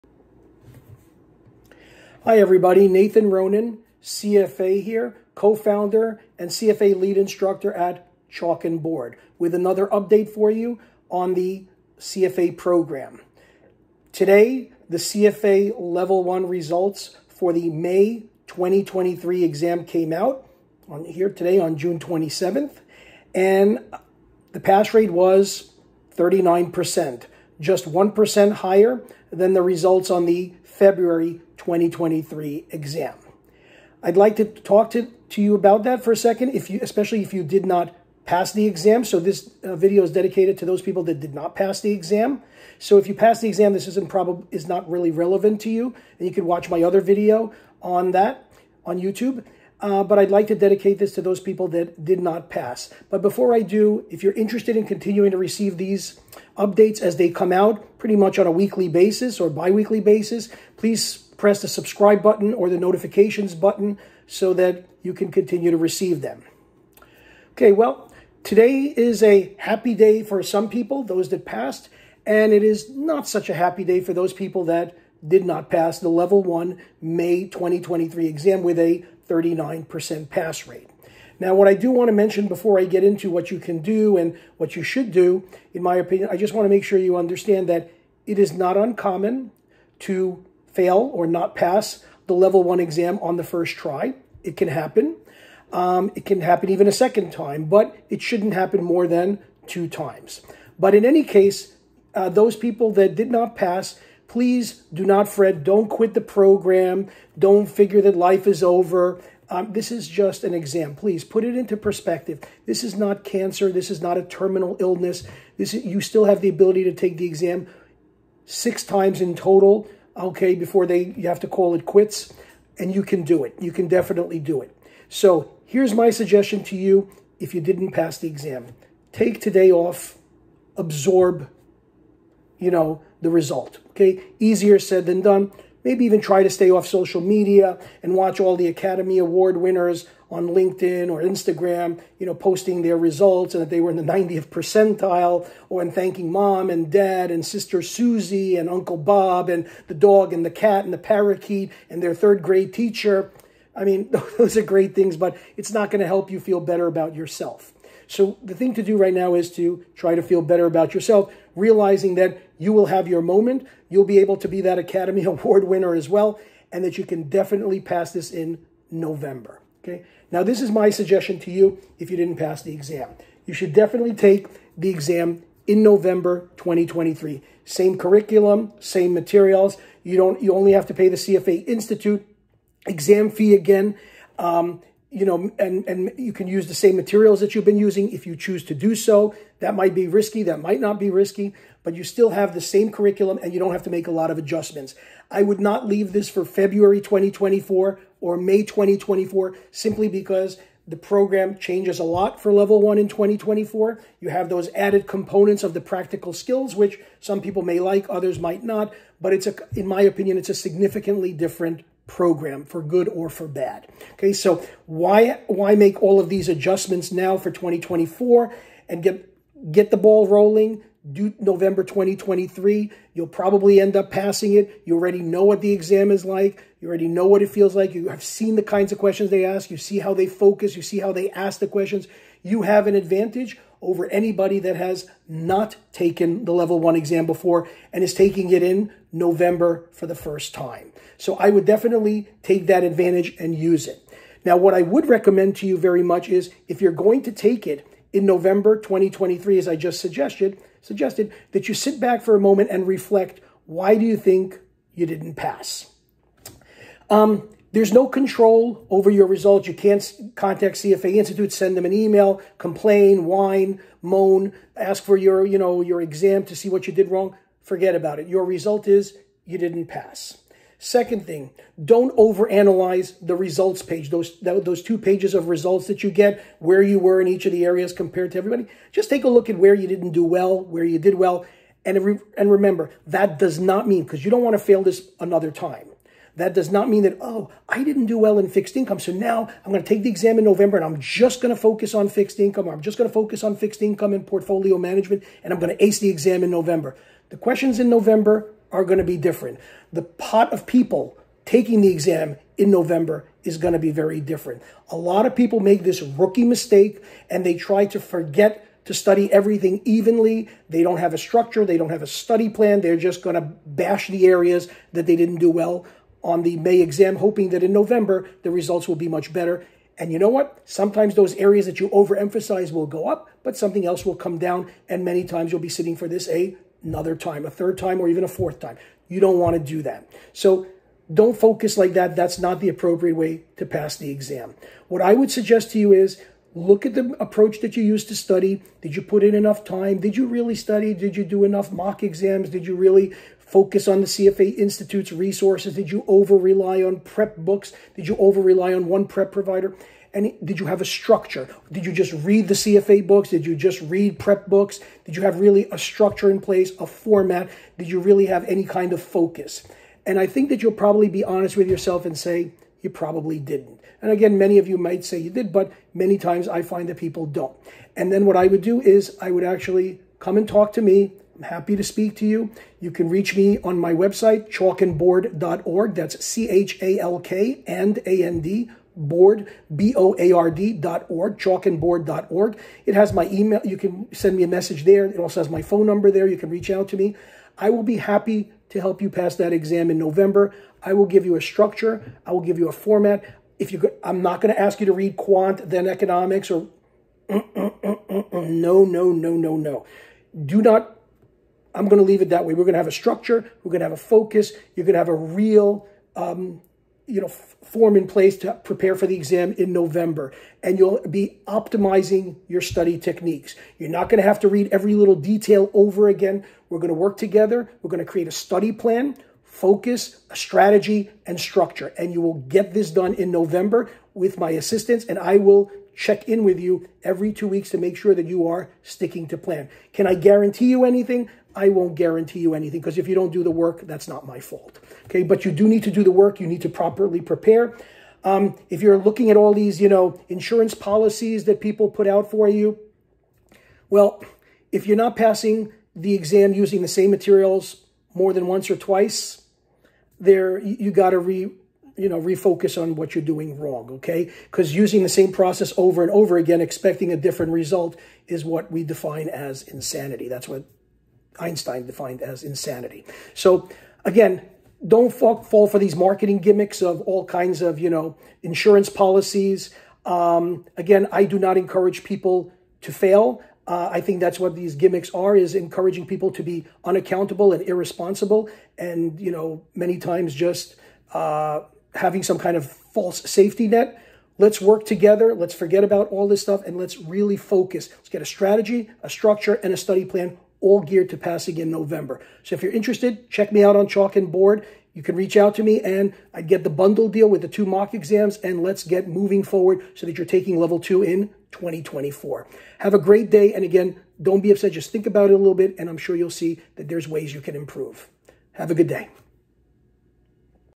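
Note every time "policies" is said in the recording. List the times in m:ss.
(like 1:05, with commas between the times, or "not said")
7:20, 7:48.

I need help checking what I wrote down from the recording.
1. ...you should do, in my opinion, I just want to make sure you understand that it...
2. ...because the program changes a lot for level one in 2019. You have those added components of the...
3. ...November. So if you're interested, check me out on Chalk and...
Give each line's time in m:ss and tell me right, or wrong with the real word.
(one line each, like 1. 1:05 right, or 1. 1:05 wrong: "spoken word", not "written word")
1. 1:24 right
2. 3:20 wrong: "2024", not "2019"
3. 8:11 right.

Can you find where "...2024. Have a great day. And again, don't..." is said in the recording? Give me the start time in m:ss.
8:21.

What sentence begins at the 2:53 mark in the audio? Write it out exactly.
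You should definitely take the exam in November 2023.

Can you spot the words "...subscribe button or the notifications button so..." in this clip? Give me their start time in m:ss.
1:01.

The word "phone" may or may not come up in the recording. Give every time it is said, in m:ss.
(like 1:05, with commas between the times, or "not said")
6:25.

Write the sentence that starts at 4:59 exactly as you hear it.
The pot of people taking the exam in November is going to be very different.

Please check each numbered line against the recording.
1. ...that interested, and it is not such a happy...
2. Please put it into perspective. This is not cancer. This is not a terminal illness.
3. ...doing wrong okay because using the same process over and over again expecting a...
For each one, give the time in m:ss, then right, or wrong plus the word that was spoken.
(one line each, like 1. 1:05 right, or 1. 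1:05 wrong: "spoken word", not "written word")
1. 1:11 wrong: "passed", not "interested"
2. 1:50 right
3. 7:33 right.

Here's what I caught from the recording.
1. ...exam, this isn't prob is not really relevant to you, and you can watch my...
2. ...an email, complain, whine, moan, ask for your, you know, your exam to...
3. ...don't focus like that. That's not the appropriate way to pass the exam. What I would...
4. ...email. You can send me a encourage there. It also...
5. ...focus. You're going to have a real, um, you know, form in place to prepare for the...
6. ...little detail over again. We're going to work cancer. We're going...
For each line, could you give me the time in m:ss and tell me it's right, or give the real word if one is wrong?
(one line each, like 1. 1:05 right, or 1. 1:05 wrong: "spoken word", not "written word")
1. 0:43 right
2. 4:21 right
3. 5:31 right
4. 6:23 wrong: "message", not "encourage"
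5. 6:43 right
6. 6:54 wrong: "together", not "cancer".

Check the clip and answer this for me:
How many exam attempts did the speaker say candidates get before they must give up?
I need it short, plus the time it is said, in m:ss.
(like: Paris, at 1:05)
6, at 1:58.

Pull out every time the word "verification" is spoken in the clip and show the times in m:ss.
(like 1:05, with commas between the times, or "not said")
not said.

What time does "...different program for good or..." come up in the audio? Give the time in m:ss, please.
3:31.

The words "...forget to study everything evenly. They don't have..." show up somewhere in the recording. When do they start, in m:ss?
5:07.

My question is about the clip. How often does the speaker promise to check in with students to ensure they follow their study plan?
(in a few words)
every two weeks.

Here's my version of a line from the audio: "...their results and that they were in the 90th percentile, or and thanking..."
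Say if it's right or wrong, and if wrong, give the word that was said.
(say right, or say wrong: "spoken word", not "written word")
right.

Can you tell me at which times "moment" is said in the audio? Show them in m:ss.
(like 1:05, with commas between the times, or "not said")
2:43, 4:12.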